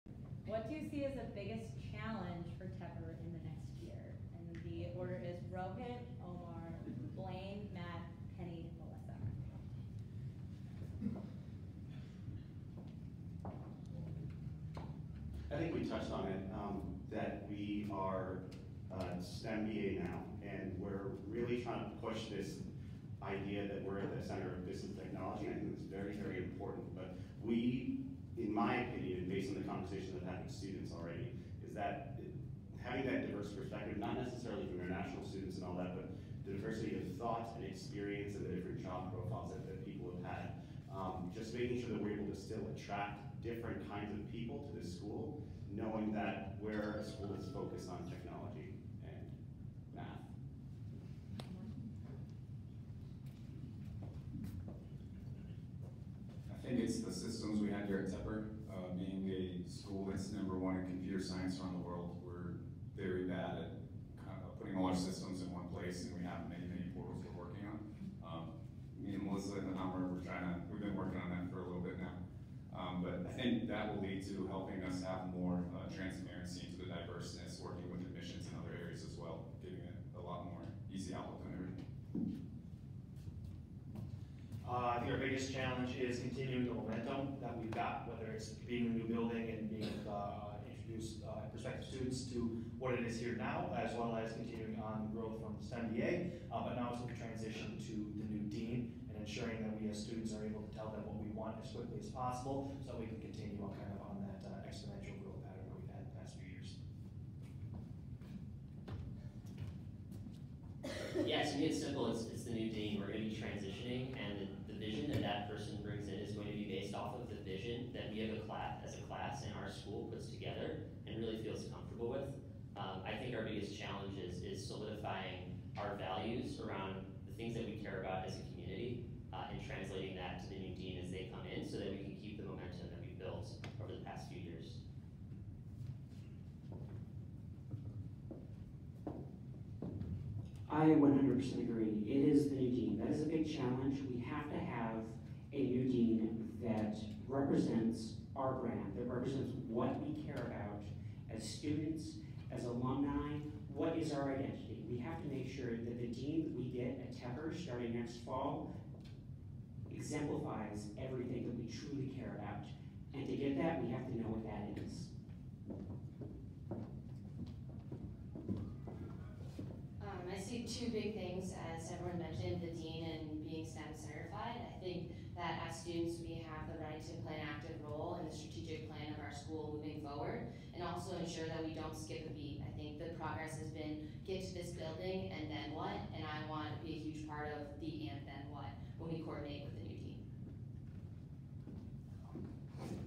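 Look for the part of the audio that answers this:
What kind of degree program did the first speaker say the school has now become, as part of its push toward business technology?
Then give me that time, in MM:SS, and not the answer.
00:19.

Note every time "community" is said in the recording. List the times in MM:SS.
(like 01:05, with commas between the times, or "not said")
02:08.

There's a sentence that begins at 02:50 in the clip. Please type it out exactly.
Um, I see two big things, as everyone mentioned, the dean and being STEM certified.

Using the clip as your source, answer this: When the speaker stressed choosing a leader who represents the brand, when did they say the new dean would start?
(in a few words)
next fall.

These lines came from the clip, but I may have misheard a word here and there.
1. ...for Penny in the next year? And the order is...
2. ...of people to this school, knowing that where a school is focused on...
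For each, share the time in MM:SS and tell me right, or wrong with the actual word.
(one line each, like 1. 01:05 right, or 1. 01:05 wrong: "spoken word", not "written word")
1. 00:02 wrong: "Tepper", not "Penny"
2. 00:44 right.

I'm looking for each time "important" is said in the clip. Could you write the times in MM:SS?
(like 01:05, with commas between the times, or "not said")
00:26.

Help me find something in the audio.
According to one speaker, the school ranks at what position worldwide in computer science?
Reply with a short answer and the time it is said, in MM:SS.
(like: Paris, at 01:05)
number one, at 01:00.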